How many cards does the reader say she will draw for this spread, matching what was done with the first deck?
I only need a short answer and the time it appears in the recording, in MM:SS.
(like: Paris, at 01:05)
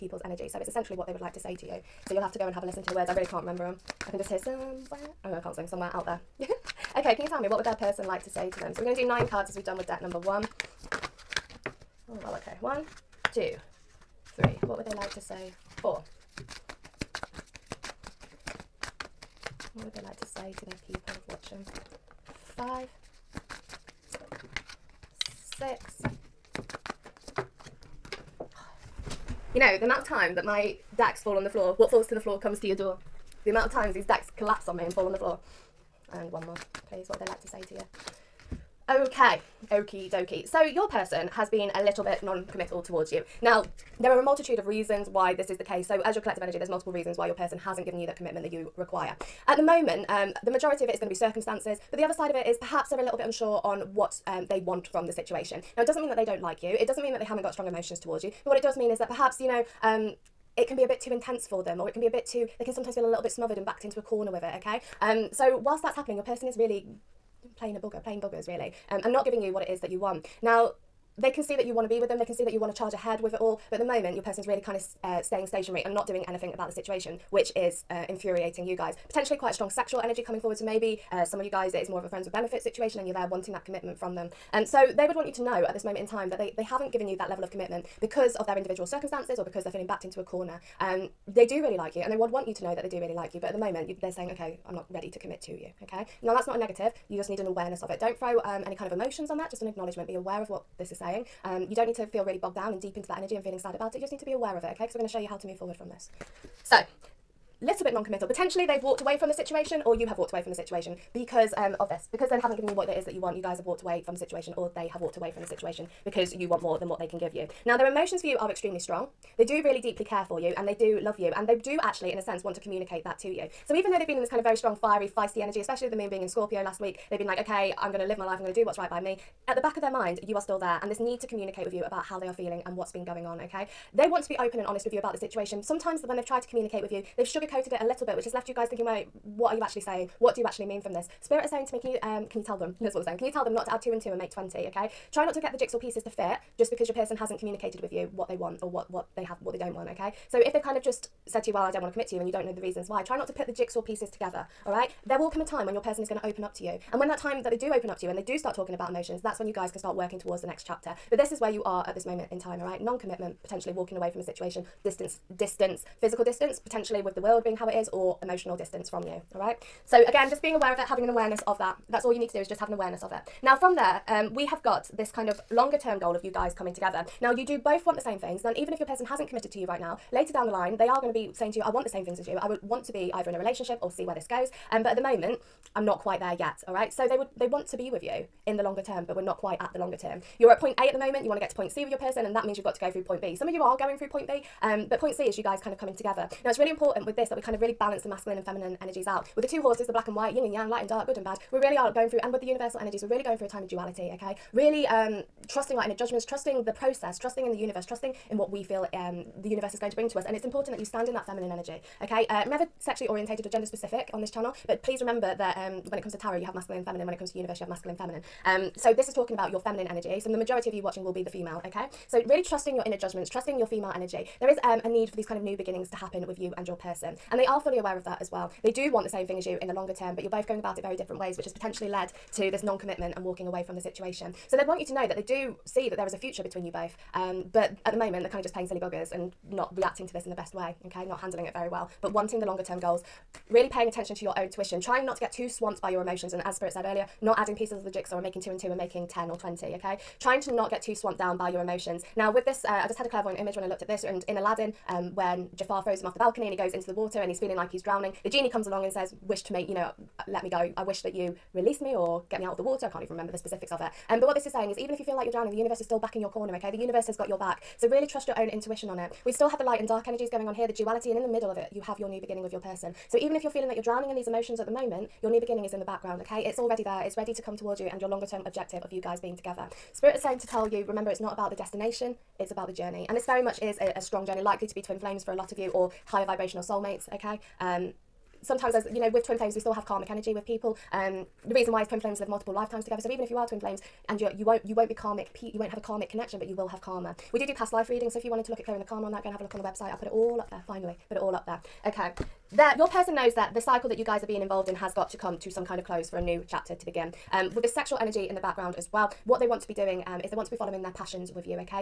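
9, at 00:09.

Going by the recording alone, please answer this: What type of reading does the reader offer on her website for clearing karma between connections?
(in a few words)
past life readings.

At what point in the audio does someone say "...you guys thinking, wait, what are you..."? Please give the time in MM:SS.
02:18.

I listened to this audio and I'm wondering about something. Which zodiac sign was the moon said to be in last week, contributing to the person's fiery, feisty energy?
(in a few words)
Scorpio.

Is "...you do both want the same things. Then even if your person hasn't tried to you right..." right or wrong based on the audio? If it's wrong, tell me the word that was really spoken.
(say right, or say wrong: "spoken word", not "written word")
wrong: "committed", not "tried".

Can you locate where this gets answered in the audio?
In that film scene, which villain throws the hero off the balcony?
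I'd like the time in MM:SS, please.
04:15.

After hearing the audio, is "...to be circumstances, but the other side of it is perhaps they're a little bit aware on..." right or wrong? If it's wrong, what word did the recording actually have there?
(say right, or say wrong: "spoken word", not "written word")
wrong: "unsure", not "aware".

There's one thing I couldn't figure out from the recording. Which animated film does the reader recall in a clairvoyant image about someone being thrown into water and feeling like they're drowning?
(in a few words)
Aladdin.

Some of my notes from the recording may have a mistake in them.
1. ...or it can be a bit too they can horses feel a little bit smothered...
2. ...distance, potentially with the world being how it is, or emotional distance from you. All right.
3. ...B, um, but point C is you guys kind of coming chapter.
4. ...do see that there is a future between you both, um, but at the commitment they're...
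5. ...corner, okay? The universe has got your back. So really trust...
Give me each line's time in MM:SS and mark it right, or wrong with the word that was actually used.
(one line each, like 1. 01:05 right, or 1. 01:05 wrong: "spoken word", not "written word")
1. 01:01 wrong: "sometimes", not "horses"
2. 02:46 right
3. 03:14 wrong: "together", not "chapter"
4. 03:55 wrong: "moment", not "commitment"
5. 04:26 right.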